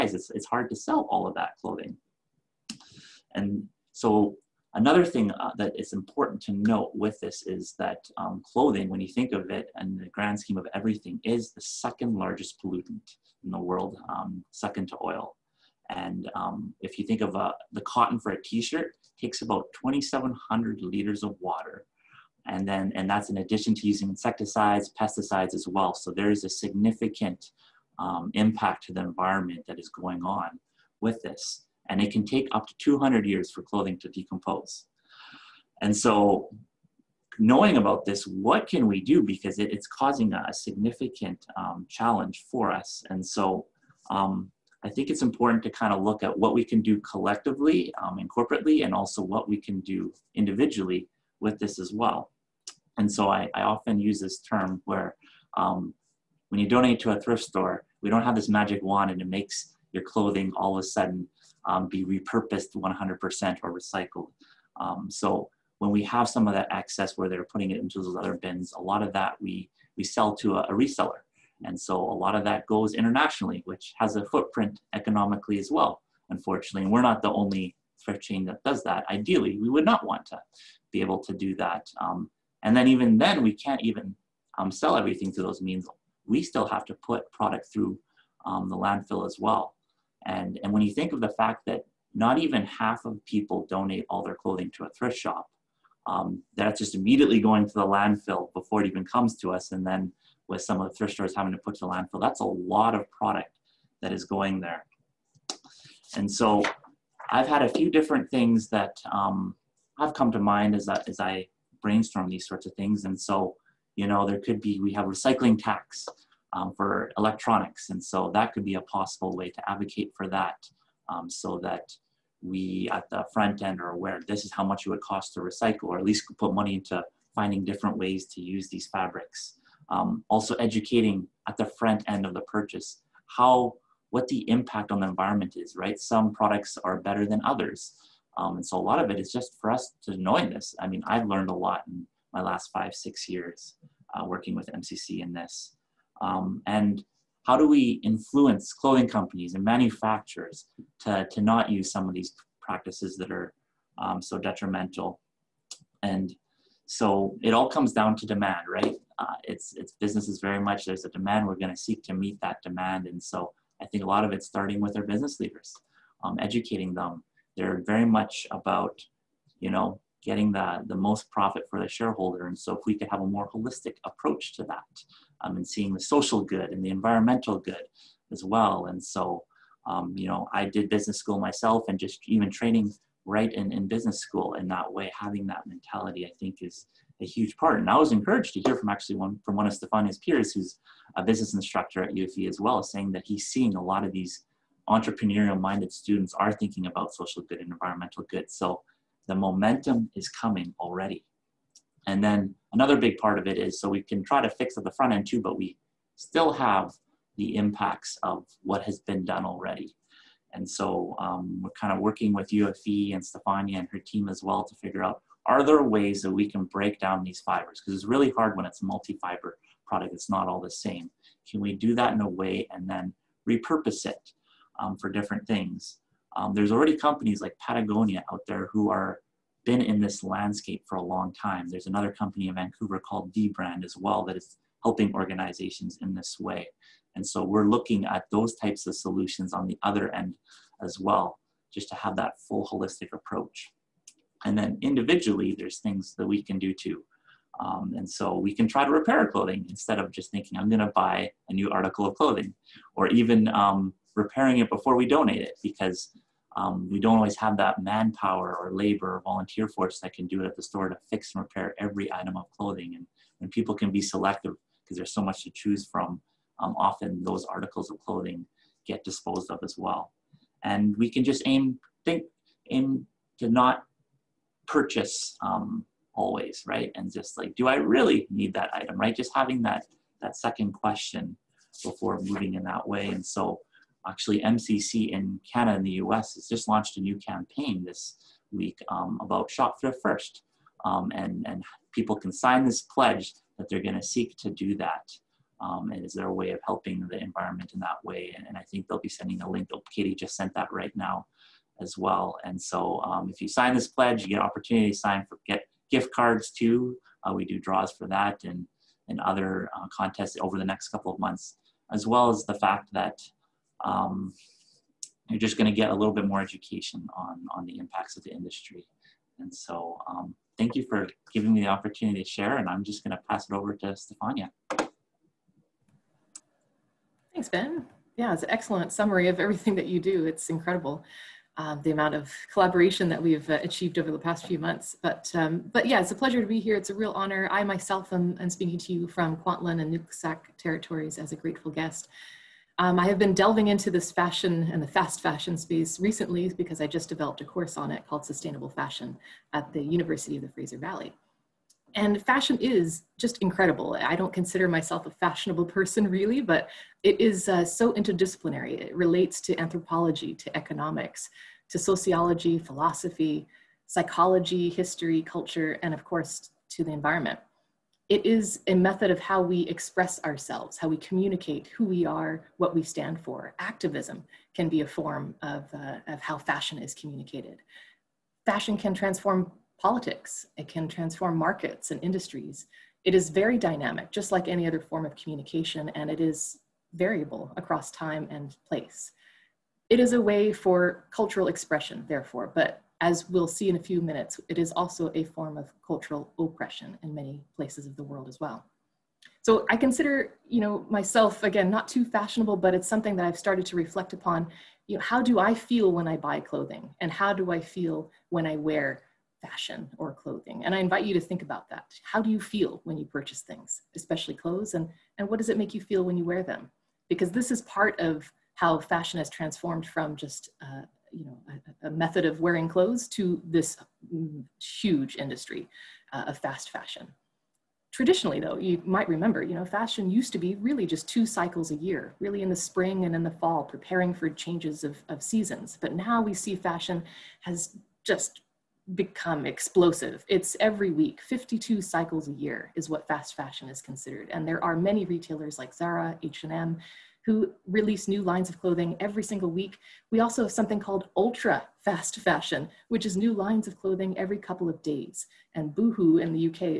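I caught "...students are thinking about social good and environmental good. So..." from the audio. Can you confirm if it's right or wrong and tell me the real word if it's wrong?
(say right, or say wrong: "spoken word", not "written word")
right.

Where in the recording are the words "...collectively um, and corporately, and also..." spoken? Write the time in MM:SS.
00:47.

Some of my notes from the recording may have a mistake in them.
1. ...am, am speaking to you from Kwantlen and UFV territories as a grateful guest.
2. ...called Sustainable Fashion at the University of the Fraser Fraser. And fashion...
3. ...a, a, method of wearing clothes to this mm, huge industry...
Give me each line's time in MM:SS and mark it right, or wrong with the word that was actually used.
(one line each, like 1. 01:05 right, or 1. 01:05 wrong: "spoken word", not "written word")
1. 05:38 wrong: "Nooksack", not "UFV"
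2. 05:48 wrong: "Valley", not "Fraser"
3. 07:01 right.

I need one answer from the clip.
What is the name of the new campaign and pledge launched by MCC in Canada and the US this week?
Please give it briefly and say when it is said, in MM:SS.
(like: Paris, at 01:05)
Shop thrift first, at 04:49.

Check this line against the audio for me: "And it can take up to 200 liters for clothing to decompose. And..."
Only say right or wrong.
wrong.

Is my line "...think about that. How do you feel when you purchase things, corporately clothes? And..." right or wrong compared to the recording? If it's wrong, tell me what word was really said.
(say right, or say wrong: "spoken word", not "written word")
wrong: "especially", not "corporately".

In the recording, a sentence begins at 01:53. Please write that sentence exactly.
And so, you know, there could be, we have recycling tax um, for electronics.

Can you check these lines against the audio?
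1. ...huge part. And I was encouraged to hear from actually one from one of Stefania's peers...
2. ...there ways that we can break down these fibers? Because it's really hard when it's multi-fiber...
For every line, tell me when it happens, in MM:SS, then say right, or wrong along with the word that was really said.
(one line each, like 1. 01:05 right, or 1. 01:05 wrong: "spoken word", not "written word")
1. 03:07 right
2. 03:35 right.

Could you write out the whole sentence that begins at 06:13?
Activism can be a form of, uh, of how fashion is communicated.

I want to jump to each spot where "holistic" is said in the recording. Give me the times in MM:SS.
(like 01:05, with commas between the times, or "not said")
02:53, 04:02.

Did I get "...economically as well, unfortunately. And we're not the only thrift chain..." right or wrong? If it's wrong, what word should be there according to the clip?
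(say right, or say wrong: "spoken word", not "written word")
right.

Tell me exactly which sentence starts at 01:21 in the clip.
Um, and then even then, we can't even um, sell everything through those means.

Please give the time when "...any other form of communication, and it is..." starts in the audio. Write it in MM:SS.
06:24.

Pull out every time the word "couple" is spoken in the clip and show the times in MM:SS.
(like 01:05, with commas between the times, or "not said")
05:10, 07:34.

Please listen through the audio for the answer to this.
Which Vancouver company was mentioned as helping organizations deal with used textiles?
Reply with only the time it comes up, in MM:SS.
03:53.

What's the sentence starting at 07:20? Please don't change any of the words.
It's every week, 52 cycles a year is what fast fashion is considered.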